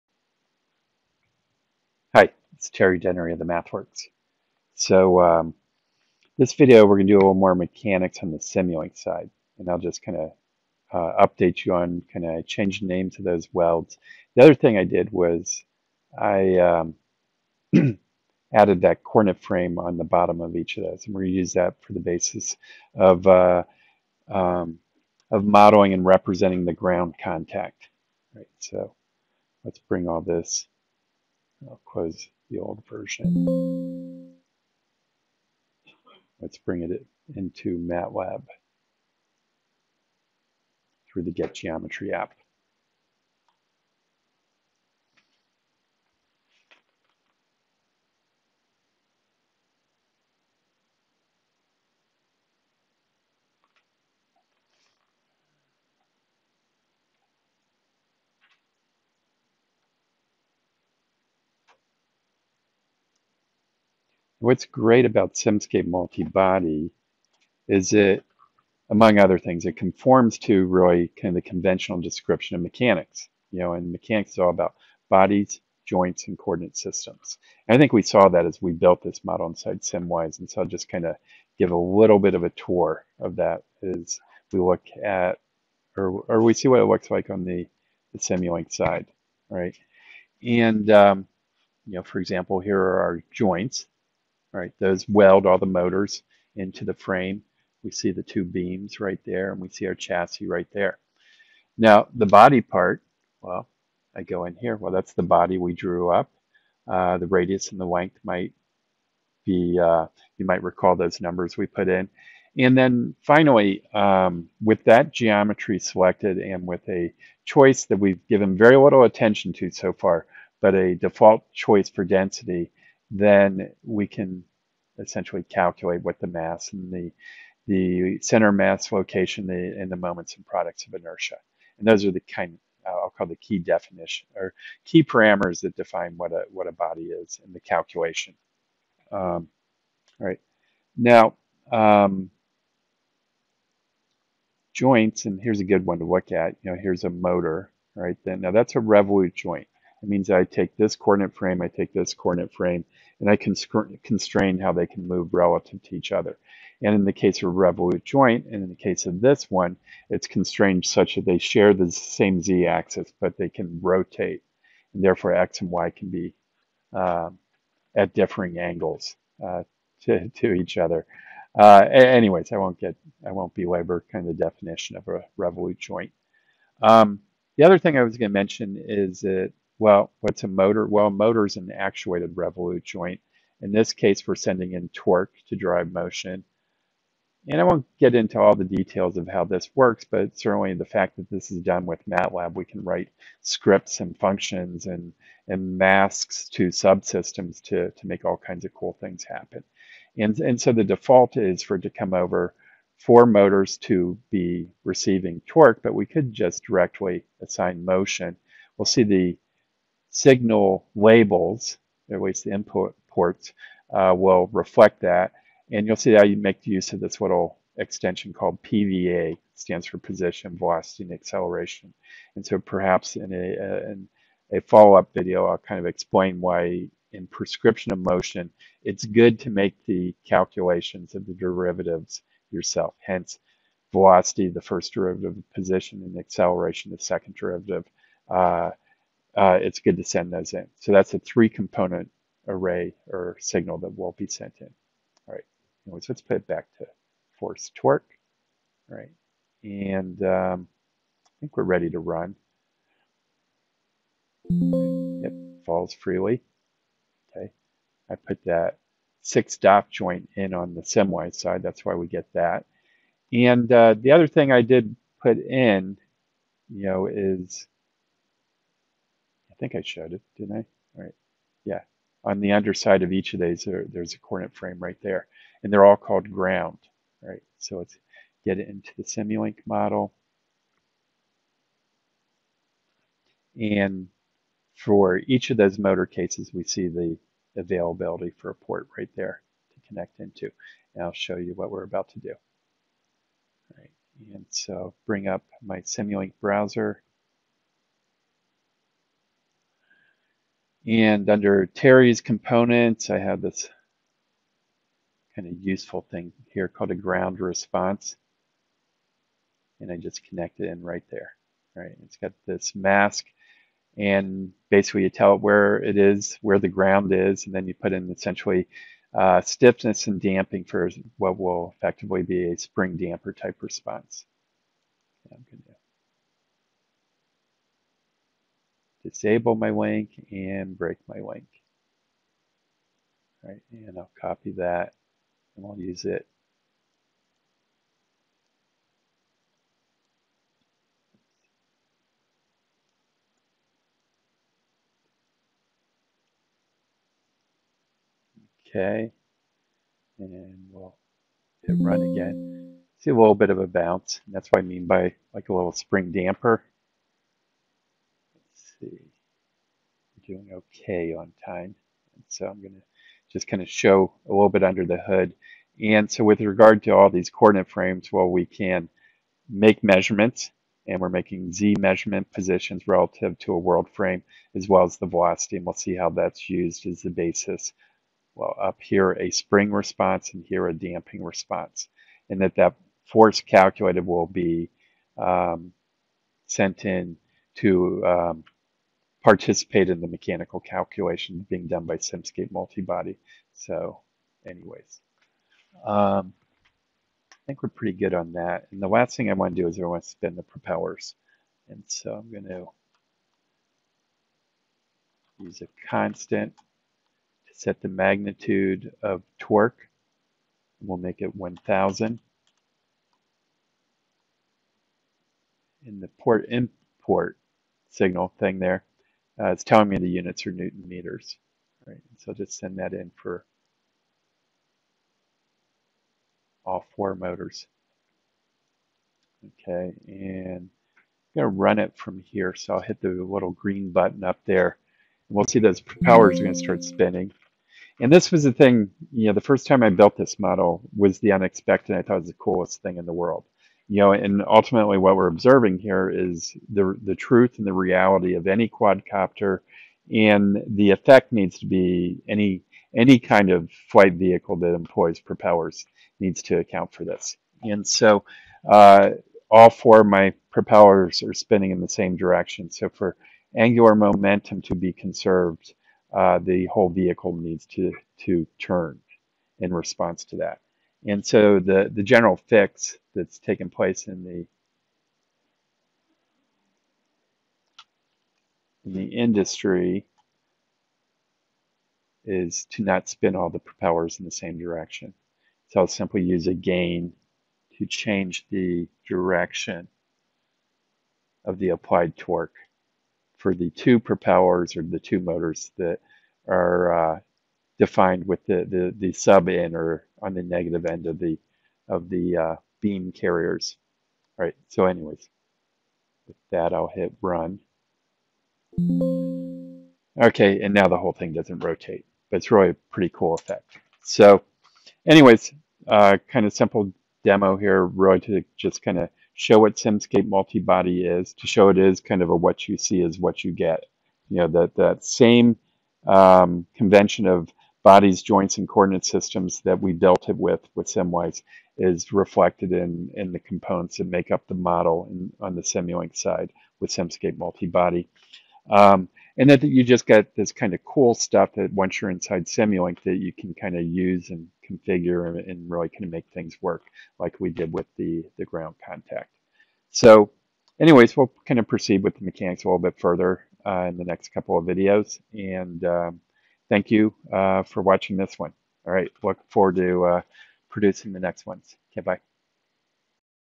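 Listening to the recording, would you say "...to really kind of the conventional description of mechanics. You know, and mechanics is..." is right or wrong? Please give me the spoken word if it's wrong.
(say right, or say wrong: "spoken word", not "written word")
right.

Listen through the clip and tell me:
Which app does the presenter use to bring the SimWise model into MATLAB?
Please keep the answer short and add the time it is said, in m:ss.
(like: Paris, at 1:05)
Get Geometry app, at 0:41.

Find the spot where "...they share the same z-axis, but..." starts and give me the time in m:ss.
2:41.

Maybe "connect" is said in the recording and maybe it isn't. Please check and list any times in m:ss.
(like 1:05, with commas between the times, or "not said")
4:49, 5:10.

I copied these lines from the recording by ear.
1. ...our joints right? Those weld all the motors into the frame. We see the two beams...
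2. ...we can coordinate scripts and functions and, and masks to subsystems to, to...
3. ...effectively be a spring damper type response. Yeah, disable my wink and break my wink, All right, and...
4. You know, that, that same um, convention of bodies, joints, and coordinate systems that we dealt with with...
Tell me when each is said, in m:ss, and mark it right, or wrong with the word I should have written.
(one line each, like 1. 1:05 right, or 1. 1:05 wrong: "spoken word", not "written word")
1. 1:33 right
2. 3:12 wrong: "write", not "coordinate"
3. 5:21 right
4. 8:44 right.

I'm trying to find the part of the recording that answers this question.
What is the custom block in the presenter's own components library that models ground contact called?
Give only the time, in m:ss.
5:06.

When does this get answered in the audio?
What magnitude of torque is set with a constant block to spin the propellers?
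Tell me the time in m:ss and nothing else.
6:51.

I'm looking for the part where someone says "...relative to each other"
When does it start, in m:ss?
2:35.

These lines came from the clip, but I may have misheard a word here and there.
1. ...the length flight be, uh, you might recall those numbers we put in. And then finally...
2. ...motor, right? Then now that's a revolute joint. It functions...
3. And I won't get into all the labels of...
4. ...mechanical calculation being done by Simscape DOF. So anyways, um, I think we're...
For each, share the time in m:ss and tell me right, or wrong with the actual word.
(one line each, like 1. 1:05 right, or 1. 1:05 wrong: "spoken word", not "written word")
1. 1:47 wrong: "might", not "flight"
2. 2:27 wrong: "means", not "functions"
3. 3:07 wrong: "details", not "labels"
4. 6:30 wrong: "Multibody", not "DOF".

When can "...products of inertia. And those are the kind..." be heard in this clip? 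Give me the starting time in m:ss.
2:10.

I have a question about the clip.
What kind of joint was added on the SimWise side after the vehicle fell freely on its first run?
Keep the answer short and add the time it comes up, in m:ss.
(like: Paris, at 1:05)
six DOF joint, at 4:19.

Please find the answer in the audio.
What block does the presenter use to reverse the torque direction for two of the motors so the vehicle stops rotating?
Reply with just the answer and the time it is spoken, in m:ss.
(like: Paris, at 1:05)
a gain, at 8:06.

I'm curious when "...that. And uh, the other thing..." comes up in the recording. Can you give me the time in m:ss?
4:22.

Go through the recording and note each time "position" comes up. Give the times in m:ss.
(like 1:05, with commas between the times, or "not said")
3:39, 3:55, 6:12.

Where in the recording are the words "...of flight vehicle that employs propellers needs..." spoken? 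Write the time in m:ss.
7:33.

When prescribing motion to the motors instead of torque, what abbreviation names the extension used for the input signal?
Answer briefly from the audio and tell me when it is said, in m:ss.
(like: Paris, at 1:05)
PVA, at 3:38.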